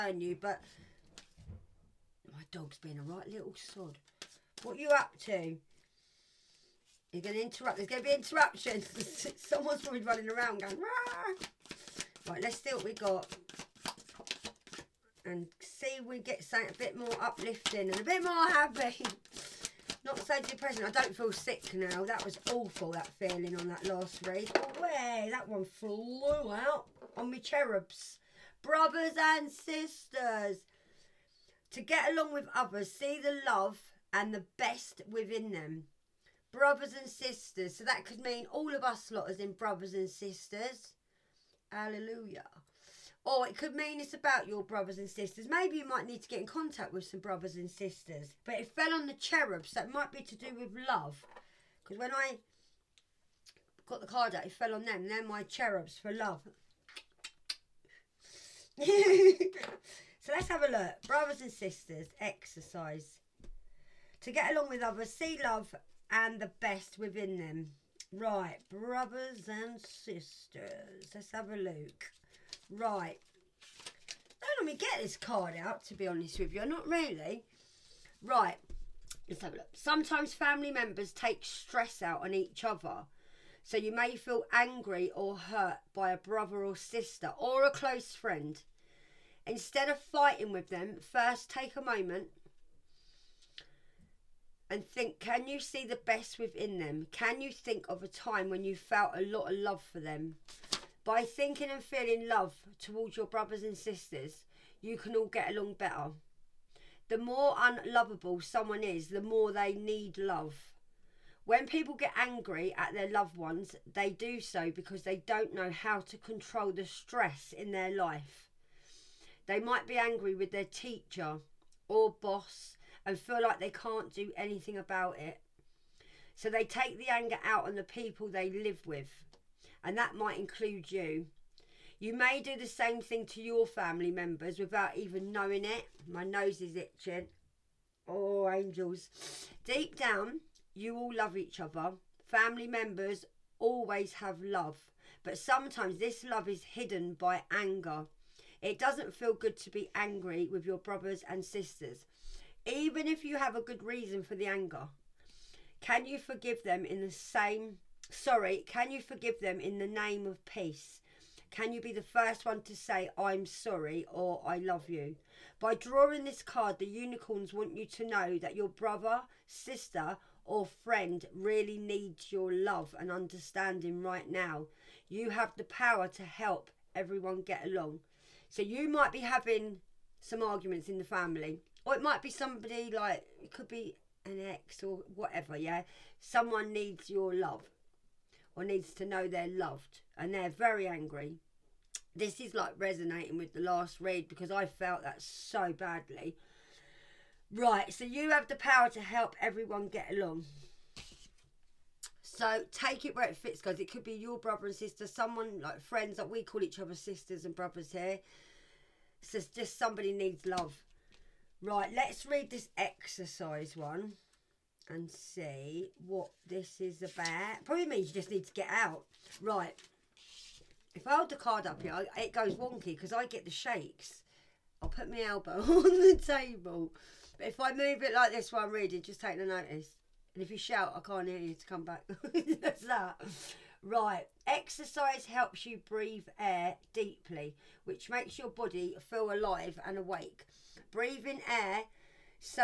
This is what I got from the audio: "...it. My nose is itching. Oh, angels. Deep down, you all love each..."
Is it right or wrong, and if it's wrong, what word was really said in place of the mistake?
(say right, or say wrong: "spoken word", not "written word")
right.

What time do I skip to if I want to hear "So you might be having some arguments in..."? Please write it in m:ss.
2:58.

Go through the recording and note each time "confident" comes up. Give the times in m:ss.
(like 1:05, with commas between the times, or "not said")
not said.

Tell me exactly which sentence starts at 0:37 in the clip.
So that could mean all of us lot as in brothers and sisters.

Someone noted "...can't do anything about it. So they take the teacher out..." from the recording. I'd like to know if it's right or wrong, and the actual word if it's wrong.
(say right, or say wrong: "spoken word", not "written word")
wrong: "anger", not "teacher".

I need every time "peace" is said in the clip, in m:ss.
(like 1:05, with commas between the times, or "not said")
2:40.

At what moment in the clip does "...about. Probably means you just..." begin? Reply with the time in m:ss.
3:37.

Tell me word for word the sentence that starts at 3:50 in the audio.
And if you shout, I can't hear you to come back.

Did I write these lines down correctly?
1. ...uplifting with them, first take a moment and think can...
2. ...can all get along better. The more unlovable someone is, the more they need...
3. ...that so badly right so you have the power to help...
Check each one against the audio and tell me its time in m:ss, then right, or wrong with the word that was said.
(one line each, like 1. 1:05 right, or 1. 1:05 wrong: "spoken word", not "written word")
1. 1:29 wrong: "fighting", not "uplifting"
2. 1:44 right
3. 3:15 right.